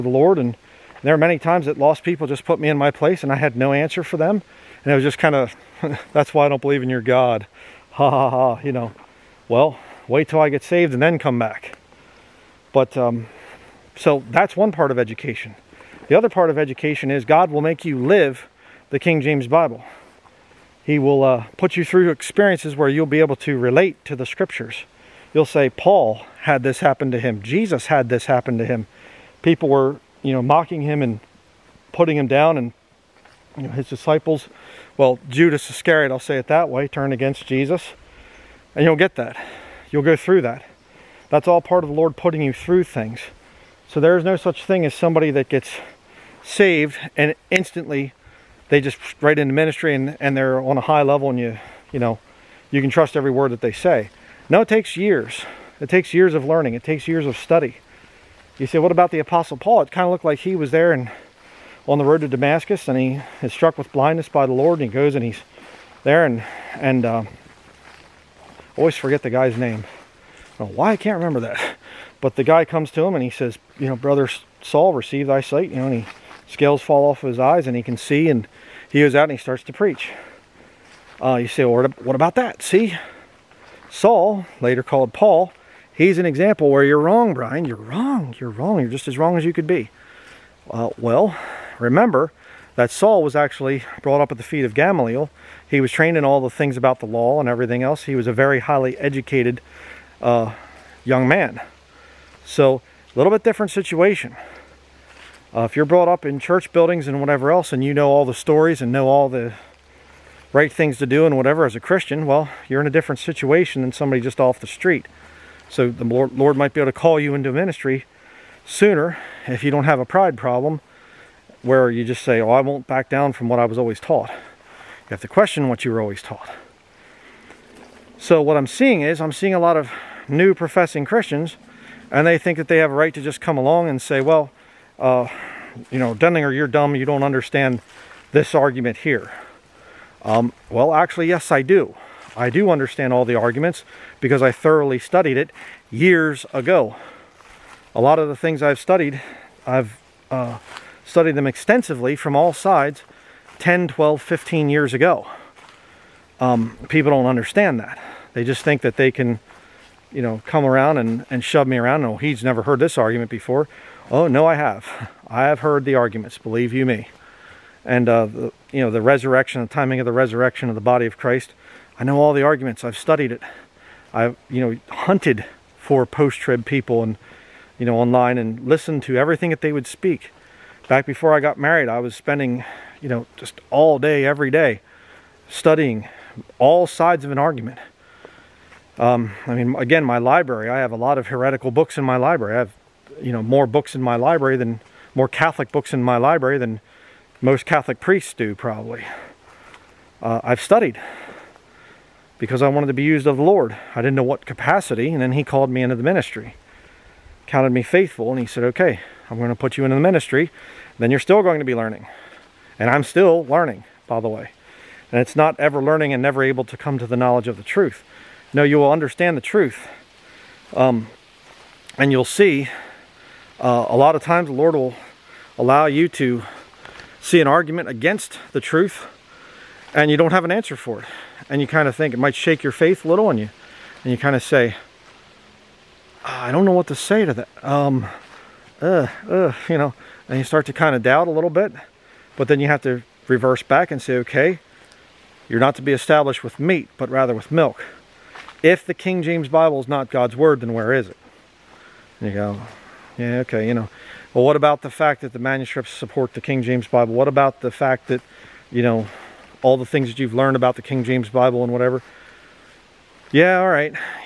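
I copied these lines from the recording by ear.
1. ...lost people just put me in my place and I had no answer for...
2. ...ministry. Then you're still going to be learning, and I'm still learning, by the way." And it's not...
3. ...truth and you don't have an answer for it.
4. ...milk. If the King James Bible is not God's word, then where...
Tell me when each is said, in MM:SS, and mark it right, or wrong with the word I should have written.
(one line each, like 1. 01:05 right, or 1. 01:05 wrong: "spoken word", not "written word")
1. 00:01 right
2. 03:30 right
3. 03:48 right
4. 04:07 right.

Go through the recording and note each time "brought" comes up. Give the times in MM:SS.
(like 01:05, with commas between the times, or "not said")
01:34, 01:45.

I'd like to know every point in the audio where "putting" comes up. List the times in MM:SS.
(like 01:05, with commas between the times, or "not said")
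00:31, 00:42.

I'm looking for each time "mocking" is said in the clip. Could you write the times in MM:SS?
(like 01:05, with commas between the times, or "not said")
00:30.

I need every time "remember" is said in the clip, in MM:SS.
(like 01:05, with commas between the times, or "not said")
01:11, 01:31.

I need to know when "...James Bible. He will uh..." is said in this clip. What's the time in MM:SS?
00:19.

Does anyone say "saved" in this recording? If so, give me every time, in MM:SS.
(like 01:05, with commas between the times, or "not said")
00:10, 00:46.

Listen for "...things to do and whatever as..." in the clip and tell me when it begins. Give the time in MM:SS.
01:50.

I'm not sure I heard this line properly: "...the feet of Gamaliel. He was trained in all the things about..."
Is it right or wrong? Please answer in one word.
right.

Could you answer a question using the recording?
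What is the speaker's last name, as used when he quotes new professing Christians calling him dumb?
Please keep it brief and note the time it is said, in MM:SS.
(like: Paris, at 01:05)
Denlinger, at 02:16.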